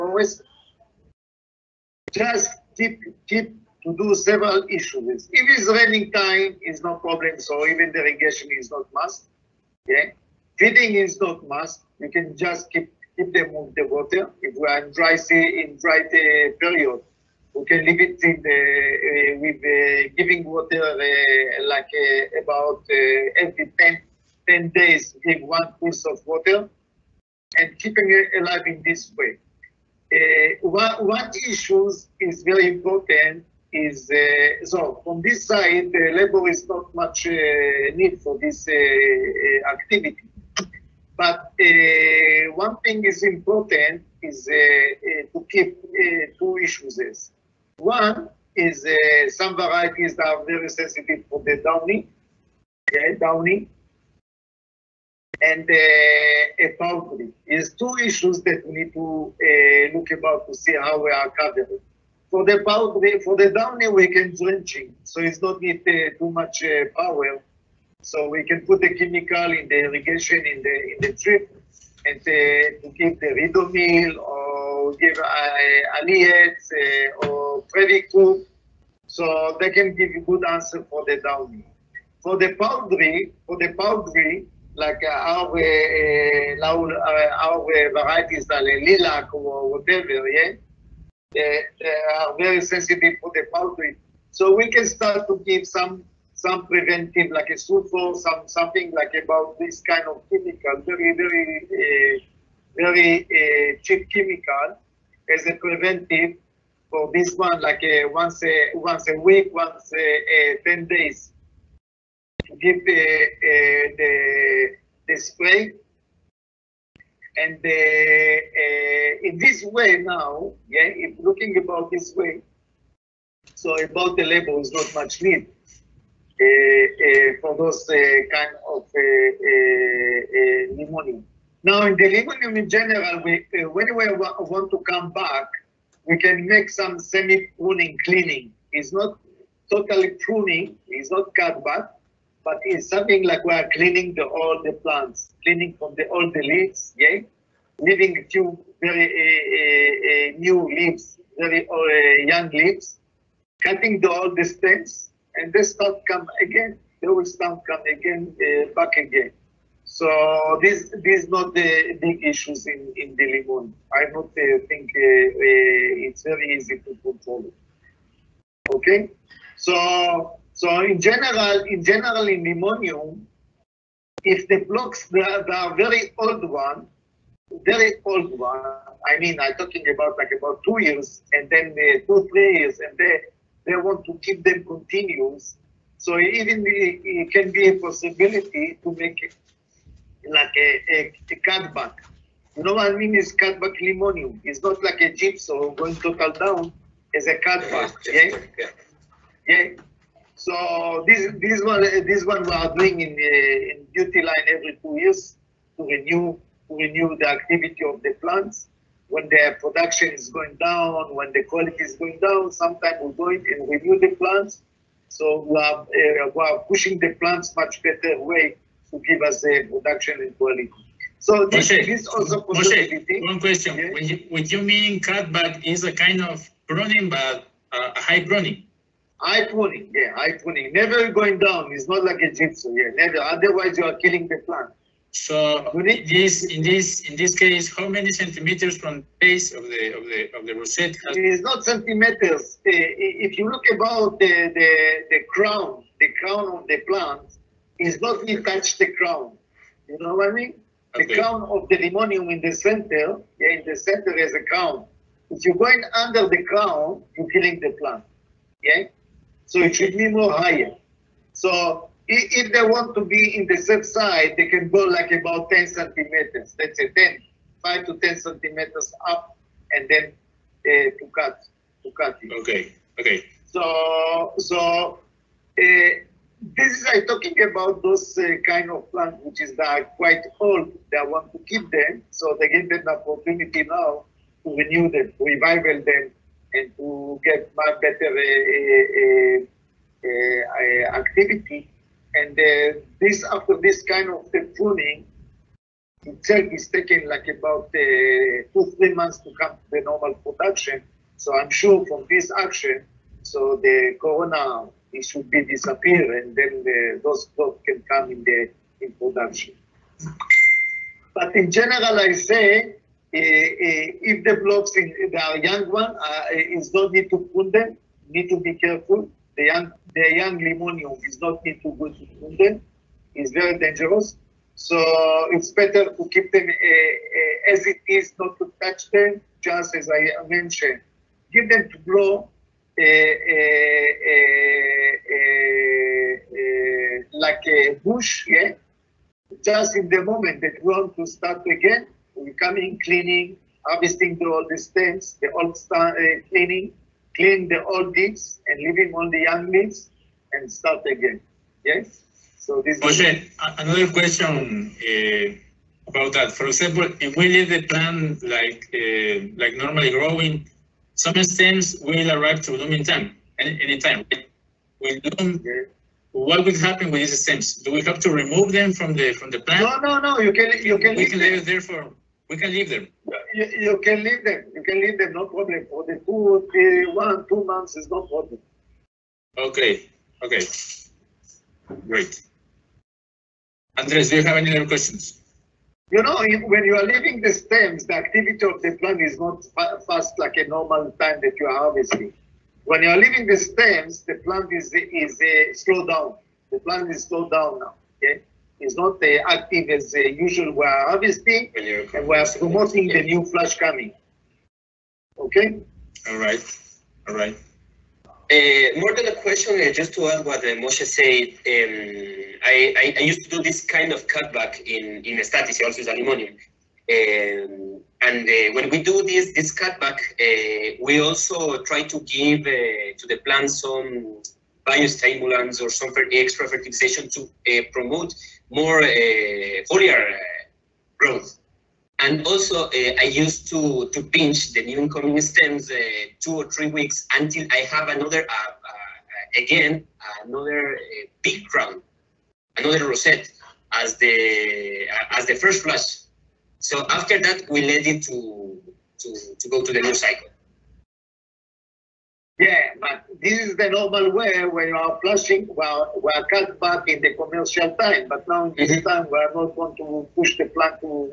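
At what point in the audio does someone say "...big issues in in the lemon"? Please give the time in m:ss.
2:42.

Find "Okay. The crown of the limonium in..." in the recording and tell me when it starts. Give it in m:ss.
4:10.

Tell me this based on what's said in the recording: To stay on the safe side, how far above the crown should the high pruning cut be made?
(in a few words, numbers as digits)
5 to 10 centimeters.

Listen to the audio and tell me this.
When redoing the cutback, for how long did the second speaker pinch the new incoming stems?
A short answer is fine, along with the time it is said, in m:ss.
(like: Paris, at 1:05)
two or three weeks, at 7:16.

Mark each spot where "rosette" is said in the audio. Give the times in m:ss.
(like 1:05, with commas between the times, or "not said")
4:00, 7:22.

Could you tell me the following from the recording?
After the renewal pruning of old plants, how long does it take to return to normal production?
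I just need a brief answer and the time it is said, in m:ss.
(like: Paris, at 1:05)
two, three months, at 4:57.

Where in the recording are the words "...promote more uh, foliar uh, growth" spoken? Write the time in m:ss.
7:07.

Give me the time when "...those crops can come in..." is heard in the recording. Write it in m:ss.
5:07.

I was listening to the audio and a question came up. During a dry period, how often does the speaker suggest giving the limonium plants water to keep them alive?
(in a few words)
every 10 days.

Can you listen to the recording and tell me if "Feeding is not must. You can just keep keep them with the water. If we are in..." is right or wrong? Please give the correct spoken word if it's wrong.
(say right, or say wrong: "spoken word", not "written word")
right.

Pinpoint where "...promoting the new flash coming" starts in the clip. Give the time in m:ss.
6:42.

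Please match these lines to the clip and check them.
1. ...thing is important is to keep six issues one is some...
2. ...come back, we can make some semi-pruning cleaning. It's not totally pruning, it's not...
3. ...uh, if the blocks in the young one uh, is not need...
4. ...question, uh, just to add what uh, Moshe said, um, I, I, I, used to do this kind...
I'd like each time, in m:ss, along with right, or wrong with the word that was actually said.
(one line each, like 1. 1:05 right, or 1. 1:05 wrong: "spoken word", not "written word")
1. 0:42 wrong: "two", not "six"
2. 2:14 right
3. 5:13 right
4. 6:49 right.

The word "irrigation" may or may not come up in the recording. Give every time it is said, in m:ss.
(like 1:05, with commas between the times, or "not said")
0:08, 1:09.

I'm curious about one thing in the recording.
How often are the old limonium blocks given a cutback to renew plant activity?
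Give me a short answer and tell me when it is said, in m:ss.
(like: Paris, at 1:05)
every two years, at 3:24.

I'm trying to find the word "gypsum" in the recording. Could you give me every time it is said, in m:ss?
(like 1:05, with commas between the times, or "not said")
3:15, 3:52.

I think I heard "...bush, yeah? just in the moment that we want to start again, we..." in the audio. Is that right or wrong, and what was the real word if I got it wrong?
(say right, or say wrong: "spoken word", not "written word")
right.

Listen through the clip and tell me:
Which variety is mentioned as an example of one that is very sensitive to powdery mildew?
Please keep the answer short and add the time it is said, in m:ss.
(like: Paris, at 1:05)
lilac, at 1:28.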